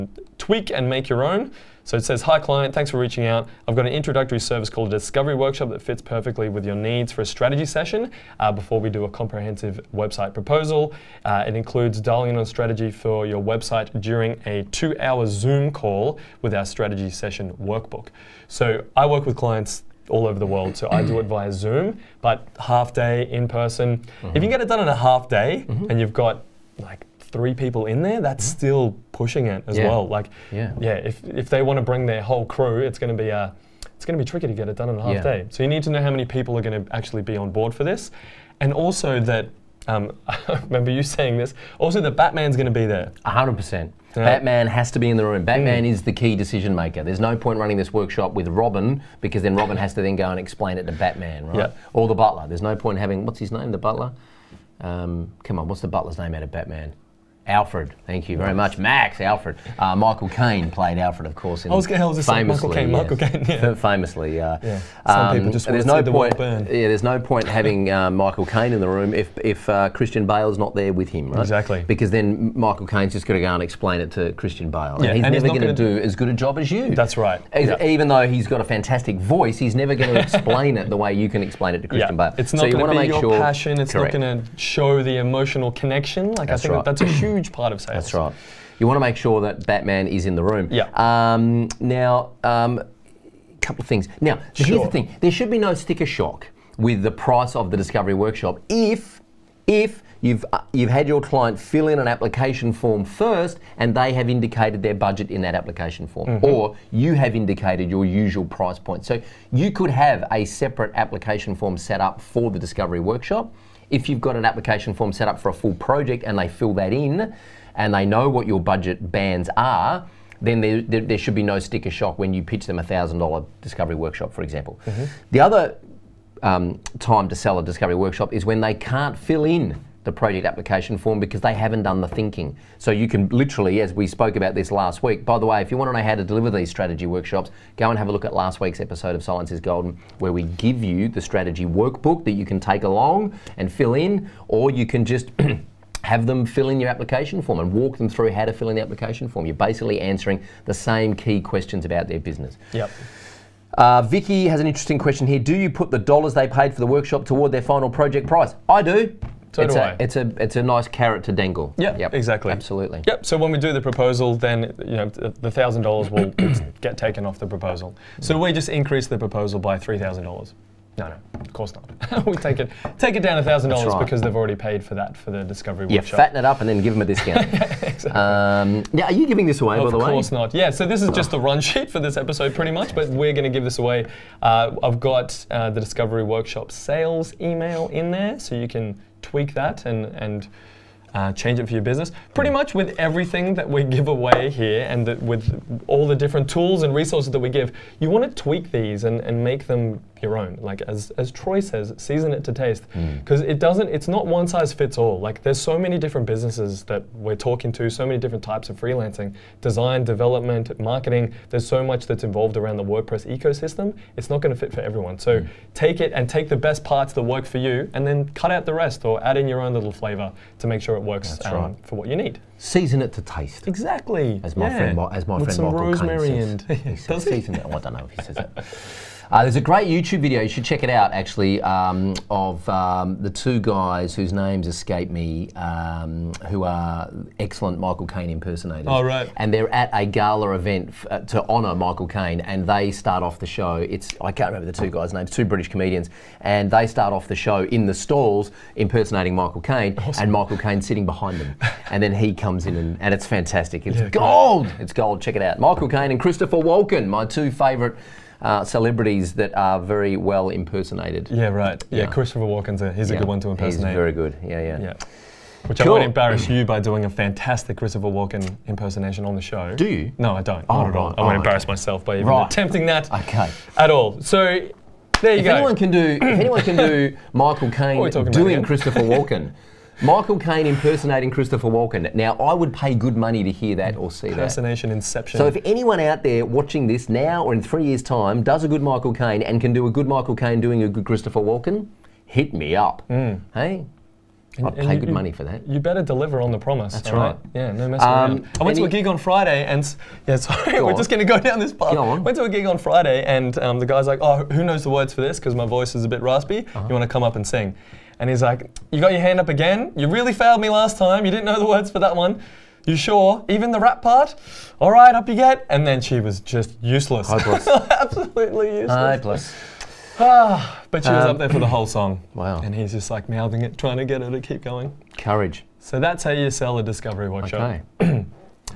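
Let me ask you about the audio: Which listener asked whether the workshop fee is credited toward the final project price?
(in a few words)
Vicky.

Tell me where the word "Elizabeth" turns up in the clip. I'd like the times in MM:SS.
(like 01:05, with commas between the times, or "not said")
not said.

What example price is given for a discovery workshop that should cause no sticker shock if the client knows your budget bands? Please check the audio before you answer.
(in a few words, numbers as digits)
$1,000.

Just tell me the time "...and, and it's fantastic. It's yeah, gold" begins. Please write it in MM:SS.
04:12.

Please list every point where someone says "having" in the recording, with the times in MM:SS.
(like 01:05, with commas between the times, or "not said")
00:52, 01:07.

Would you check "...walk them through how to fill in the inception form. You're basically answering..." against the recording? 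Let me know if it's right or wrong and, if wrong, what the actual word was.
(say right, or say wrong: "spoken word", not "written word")
wrong: "application", not "inception".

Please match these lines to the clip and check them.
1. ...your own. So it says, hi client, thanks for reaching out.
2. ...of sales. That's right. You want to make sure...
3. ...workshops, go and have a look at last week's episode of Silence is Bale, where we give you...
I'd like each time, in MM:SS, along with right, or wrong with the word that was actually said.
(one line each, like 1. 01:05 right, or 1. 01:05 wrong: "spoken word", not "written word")
1. 00:01 right
2. 01:27 right
3. 02:17 wrong: "Golden", not "Bale".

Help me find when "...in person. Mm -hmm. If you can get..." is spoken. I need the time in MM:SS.
00:23.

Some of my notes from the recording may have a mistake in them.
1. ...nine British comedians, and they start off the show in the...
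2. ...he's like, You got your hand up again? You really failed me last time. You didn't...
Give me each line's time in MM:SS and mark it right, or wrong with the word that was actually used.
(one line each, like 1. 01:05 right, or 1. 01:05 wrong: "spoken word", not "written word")
1. 04:05 wrong: "two", not "nine"
2. 05:08 right.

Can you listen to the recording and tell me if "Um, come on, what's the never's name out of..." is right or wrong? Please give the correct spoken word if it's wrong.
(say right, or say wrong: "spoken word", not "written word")
wrong: "butler", not "never".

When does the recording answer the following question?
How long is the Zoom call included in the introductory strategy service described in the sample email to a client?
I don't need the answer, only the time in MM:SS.
00:14.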